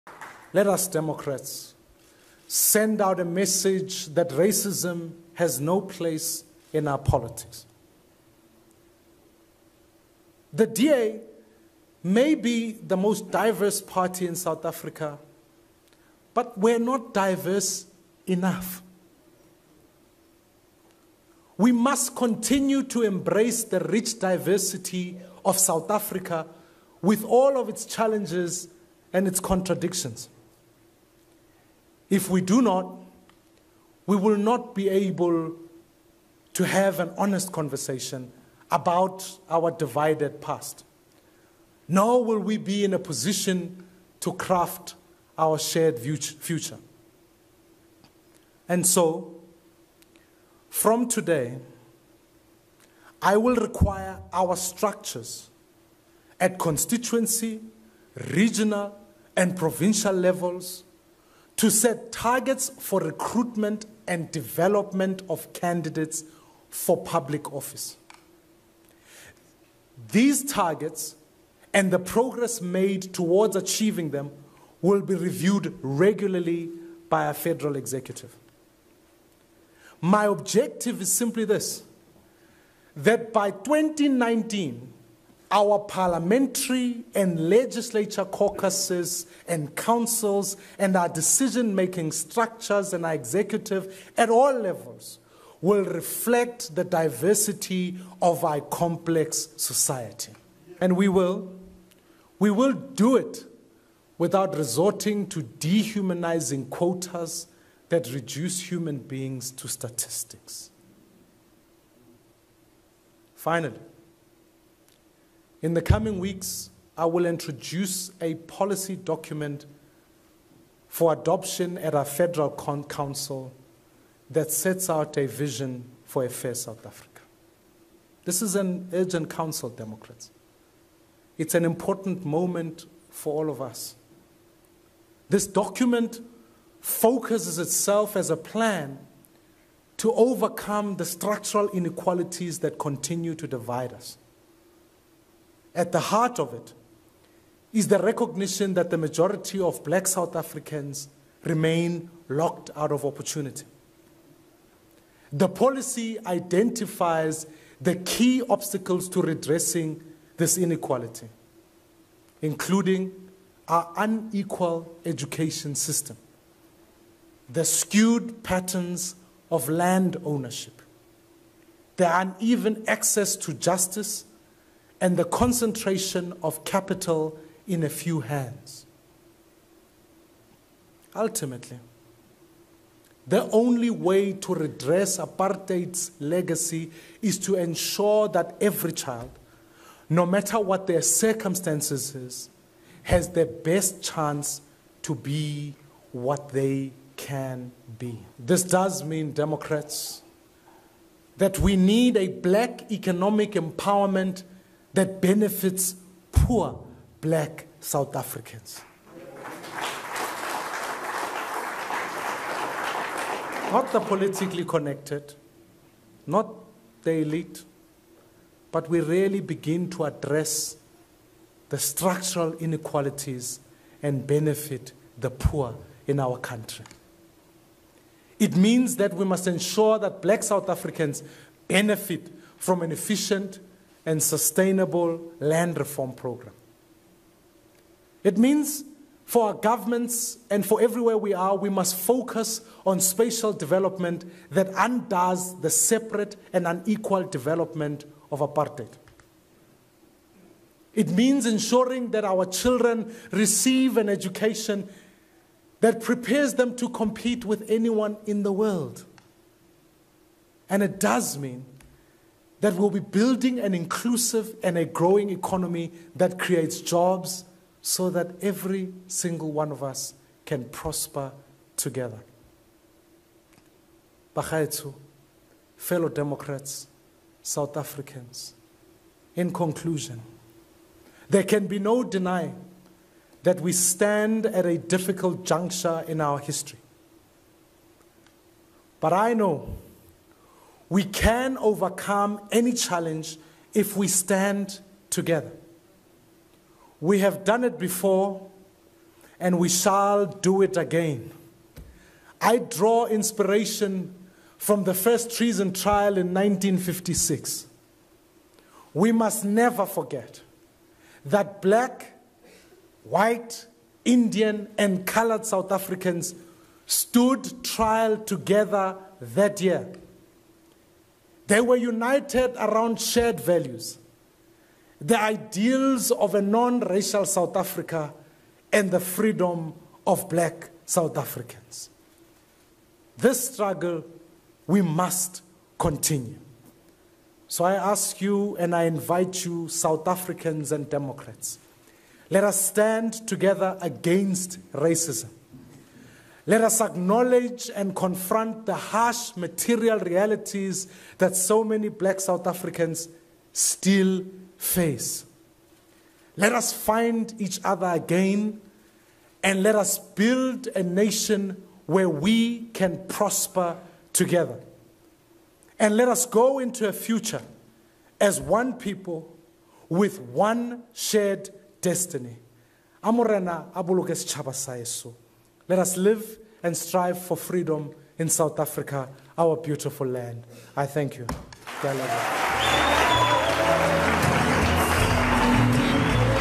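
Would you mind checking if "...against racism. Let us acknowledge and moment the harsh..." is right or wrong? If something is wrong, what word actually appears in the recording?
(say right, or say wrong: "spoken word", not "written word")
wrong: "confront", not "moment".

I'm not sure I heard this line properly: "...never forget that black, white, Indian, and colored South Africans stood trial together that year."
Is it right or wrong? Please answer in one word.
right.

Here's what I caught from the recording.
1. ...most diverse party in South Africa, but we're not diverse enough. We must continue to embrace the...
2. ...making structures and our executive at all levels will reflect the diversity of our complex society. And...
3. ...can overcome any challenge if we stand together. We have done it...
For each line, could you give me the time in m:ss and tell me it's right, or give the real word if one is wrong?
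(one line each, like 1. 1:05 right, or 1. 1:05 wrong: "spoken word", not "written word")
1. 0:12 right
2. 1:31 right
3. 4:51 right.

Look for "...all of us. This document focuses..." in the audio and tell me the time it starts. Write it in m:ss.
2:13.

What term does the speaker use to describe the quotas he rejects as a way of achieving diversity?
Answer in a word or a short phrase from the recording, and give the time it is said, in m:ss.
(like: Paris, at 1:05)
dehumanizing, at 1:45.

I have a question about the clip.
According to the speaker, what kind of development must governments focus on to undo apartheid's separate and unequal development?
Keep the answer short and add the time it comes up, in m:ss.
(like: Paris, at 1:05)
spatial development, at 4:02.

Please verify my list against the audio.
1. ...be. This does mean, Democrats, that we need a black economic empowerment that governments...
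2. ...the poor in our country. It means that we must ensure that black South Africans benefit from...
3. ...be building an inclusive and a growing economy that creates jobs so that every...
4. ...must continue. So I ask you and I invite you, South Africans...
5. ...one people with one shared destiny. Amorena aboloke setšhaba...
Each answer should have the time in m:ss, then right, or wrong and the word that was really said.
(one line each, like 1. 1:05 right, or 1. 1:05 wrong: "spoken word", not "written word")
1. 3:17 wrong: "benefits", not "governments"
2. 3:45 right
3. 4:22 right
4. 5:34 right
5. 6:08 right.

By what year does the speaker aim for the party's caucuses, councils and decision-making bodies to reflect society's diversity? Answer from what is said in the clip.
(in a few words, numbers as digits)
2019.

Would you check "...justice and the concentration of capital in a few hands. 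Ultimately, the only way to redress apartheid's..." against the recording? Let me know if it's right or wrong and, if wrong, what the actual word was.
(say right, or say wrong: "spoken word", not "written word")
right.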